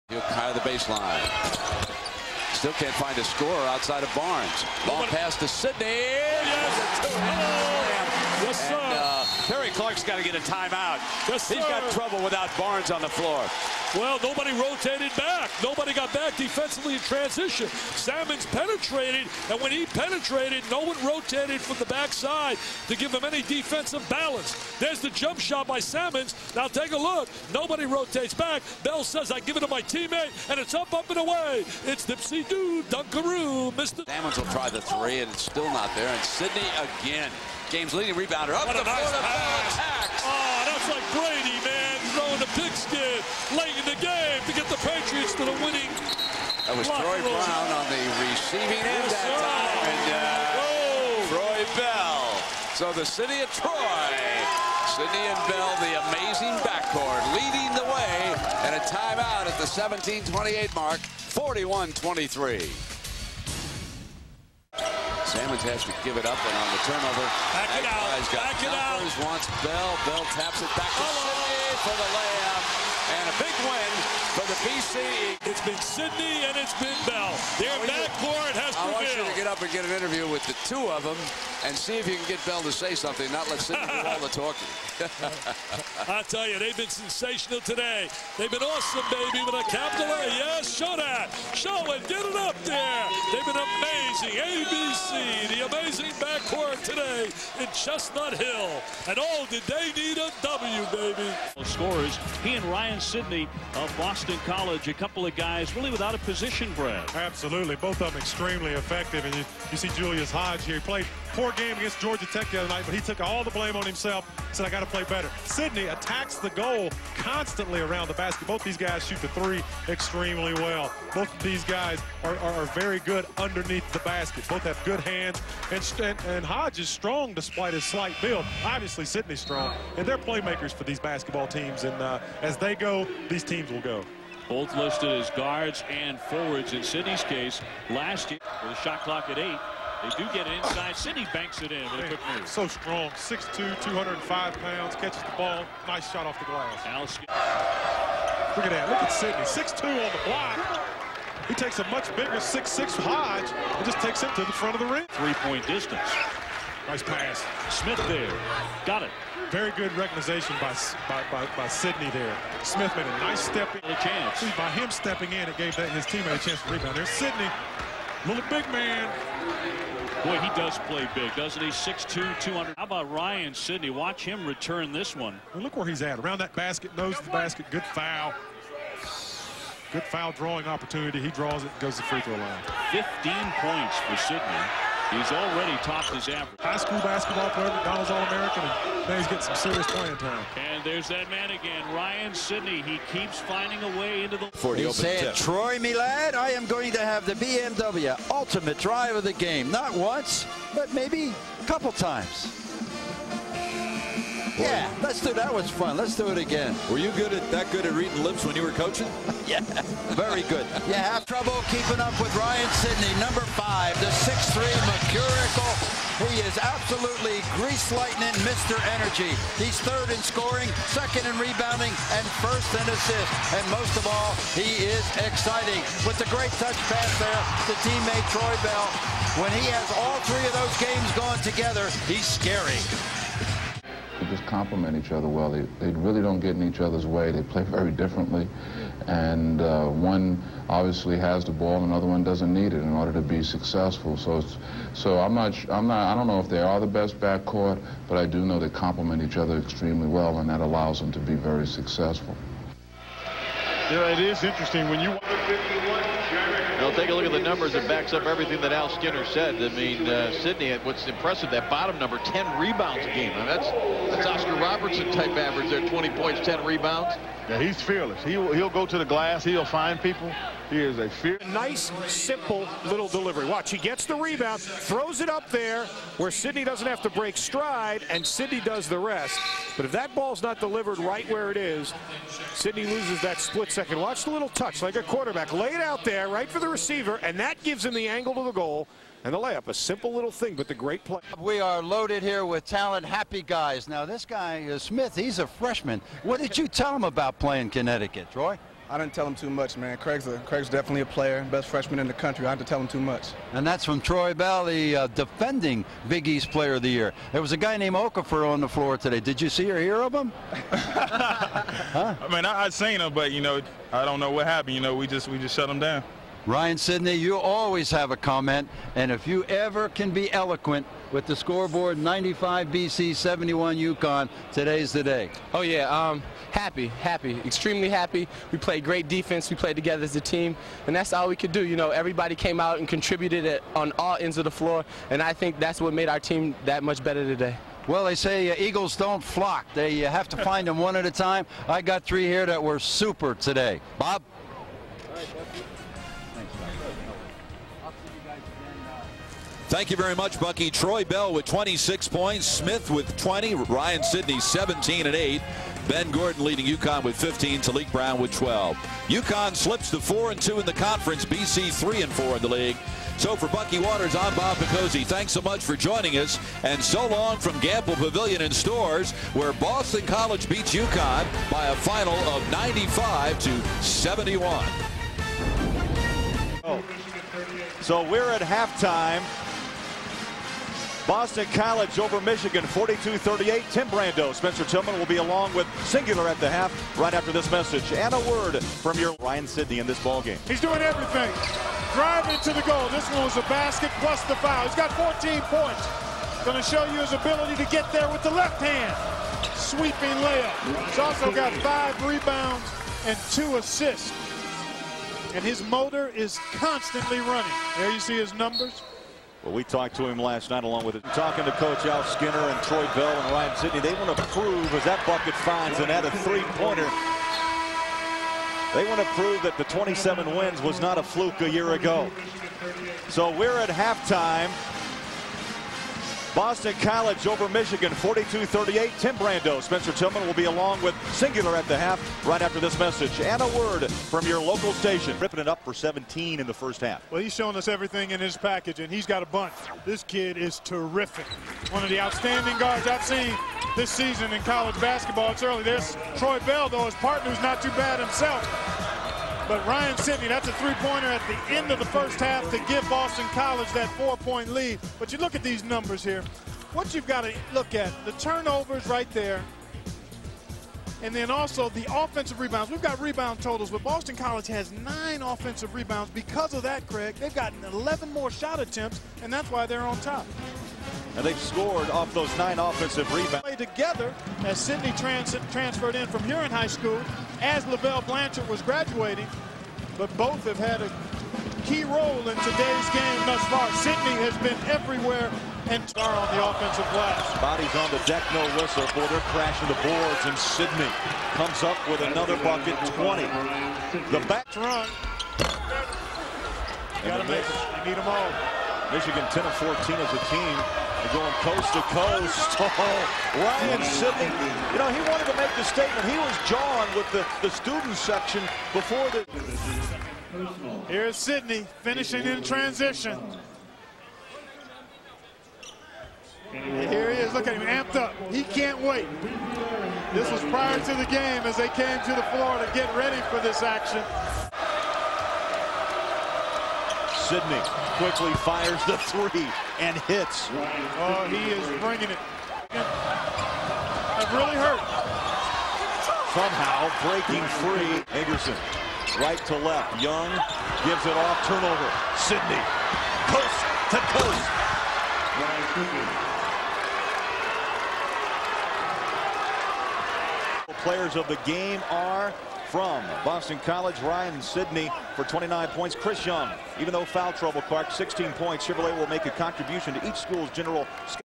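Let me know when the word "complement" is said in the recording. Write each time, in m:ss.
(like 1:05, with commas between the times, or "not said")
3:54, 4:08.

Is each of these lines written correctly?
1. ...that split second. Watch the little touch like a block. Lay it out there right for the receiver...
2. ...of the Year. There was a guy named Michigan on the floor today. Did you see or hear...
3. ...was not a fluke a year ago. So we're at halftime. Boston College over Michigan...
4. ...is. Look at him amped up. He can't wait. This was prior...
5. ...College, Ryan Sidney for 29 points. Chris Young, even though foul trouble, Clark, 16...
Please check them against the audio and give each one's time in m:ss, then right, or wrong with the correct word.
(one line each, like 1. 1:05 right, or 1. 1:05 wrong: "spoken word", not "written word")
1. 4:43 wrong: "quarterback", not "block"
2. 5:06 wrong: "Okafor", not "Michigan"
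3. 7:00 right
4. 8:37 right
5. 9:13 right.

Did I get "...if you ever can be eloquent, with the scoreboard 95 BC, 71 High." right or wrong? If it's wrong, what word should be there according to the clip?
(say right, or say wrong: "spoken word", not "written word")
wrong: "Yukon", not "High".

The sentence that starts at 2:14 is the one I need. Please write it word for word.
Both listed as guards and forwards in Sidney's case.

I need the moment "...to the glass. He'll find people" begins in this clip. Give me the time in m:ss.
4:28.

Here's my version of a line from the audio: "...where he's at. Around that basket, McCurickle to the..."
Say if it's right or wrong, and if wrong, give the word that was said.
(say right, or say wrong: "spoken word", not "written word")
wrong: "Nose", not "McCurickle".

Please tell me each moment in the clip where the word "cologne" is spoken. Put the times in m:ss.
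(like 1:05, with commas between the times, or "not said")
not said.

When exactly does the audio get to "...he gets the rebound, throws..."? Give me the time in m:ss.
4:33.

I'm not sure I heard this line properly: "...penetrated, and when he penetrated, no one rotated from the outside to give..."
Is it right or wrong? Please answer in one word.
wrong.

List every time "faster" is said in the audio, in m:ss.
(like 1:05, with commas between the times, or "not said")
not said.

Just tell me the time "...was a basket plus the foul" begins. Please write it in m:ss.
6:33.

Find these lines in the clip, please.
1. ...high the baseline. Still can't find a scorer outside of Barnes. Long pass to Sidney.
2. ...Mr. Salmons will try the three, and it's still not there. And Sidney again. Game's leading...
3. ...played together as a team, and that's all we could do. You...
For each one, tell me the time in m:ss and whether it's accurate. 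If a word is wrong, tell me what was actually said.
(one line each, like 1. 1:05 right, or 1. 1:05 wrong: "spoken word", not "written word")
1. 0:00 right
2. 0:33 right
3. 5:29 right.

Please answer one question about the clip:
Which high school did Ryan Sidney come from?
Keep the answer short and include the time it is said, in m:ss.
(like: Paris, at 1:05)
Huron High School, at 7:56.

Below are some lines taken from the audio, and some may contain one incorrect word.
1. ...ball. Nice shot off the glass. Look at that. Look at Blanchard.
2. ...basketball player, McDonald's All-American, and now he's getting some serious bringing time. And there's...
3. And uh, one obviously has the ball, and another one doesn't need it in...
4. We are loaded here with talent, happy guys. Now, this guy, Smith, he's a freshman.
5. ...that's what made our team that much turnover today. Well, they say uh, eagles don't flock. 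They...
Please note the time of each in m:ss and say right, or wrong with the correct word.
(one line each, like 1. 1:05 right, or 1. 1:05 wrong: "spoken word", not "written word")
1. 2:25 wrong: "Sidney", not "Blanchard"
2. 3:06 wrong: "playing", not "bringing"
3. 3:59 right
4. 4:51 right
5. 5:35 wrong: "better", not "turnover".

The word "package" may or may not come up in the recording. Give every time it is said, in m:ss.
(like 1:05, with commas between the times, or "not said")
7:18.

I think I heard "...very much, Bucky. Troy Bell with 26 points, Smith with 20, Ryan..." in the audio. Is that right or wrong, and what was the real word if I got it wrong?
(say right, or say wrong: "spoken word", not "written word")
right.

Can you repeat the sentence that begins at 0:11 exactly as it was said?
Yes, He's got trouble without Barnes on the floor.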